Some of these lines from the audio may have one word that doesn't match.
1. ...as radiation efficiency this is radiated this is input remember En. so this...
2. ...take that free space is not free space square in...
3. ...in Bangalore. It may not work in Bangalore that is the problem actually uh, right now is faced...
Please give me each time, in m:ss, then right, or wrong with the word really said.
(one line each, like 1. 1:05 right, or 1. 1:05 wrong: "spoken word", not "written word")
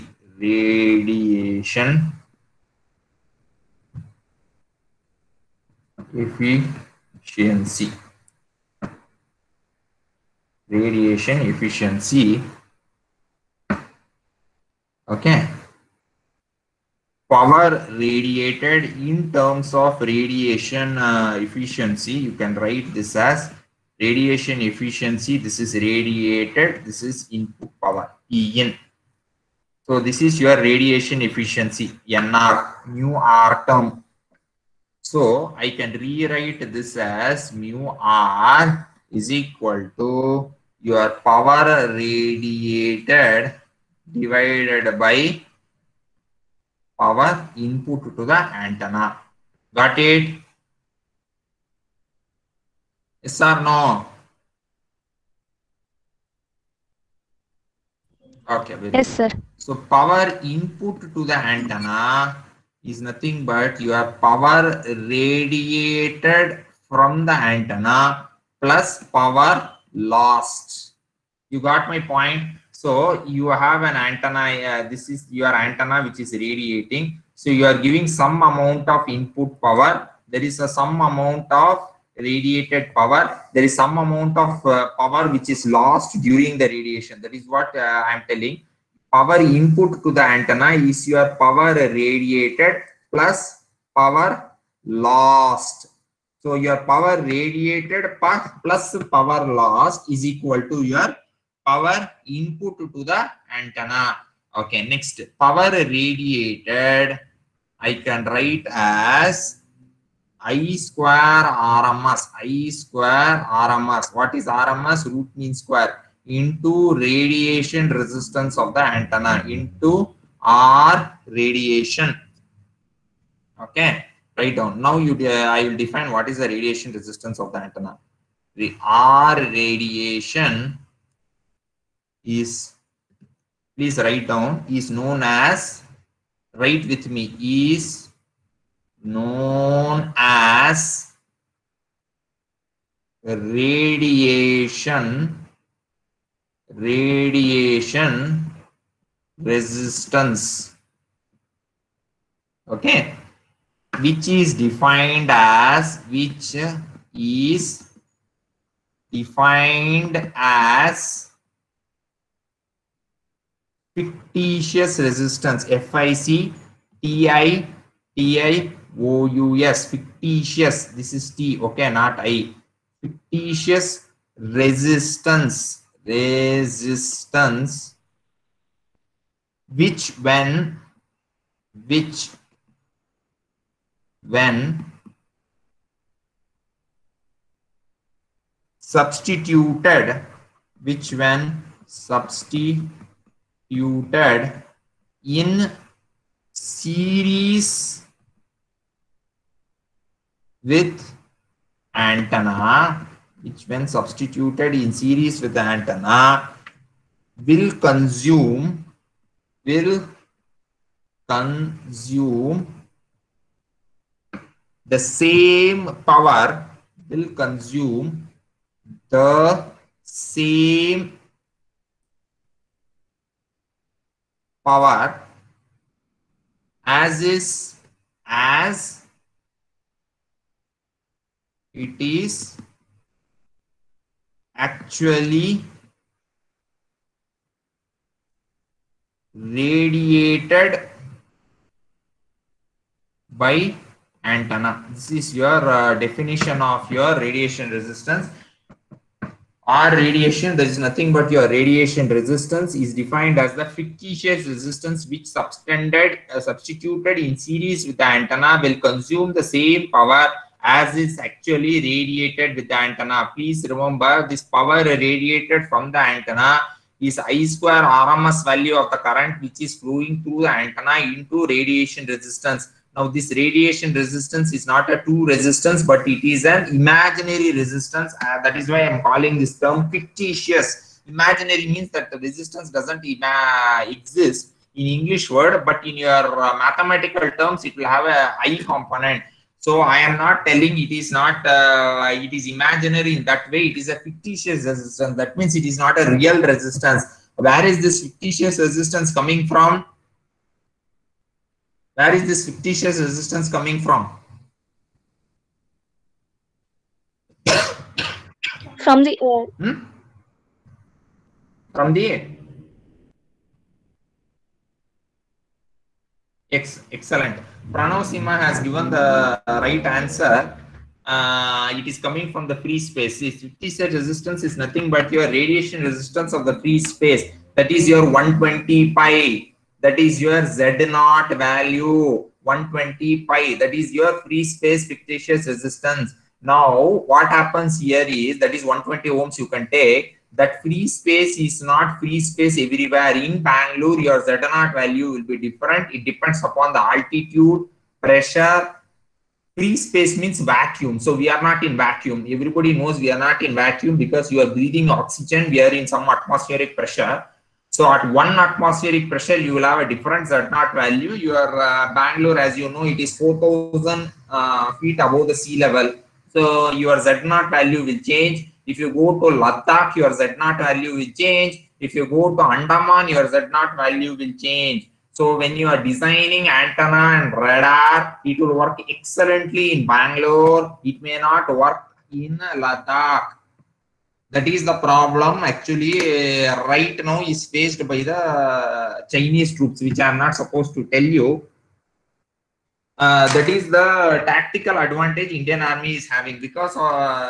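1. 0:23 wrong: "power", not "remember"
2. 5:39 wrong: "everywhere", not "square"
3. 6:19 wrong: "Ladakh", not "Bangalore".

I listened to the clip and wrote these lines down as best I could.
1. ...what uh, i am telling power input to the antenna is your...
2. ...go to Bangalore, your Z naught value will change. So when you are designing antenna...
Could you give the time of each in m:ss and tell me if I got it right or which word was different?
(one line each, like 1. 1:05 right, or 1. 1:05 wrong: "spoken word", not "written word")
1. 1:27 right
2. 6:12 wrong: "Andaman", not "Bangalore".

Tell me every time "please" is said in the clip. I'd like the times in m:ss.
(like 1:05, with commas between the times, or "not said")
2:13, 4:23.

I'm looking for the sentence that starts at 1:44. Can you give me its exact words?
Okay, next power radiated I can write as I square RMS.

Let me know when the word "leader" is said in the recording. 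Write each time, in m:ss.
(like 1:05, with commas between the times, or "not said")
not said.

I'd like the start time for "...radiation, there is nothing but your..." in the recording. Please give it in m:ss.
4:09.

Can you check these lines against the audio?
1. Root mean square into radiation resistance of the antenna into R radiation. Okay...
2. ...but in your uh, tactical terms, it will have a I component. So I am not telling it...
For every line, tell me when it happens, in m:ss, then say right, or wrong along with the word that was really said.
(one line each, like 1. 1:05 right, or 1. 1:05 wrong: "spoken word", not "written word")
1. 1:55 right
2. 4:45 wrong: "mathematical", not "tactical".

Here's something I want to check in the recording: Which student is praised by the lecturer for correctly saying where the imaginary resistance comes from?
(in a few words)
Pranav Sima.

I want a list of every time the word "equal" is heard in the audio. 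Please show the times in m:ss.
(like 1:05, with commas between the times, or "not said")
0:39, 1:40.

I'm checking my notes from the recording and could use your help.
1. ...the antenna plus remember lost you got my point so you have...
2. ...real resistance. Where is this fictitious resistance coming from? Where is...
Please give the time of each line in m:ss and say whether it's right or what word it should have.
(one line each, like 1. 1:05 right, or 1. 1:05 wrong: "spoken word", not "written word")
1. 1:07 wrong: "power", not "remember"
2. 4:56 right.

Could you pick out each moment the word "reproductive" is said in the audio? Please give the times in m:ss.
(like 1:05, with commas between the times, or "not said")
not said.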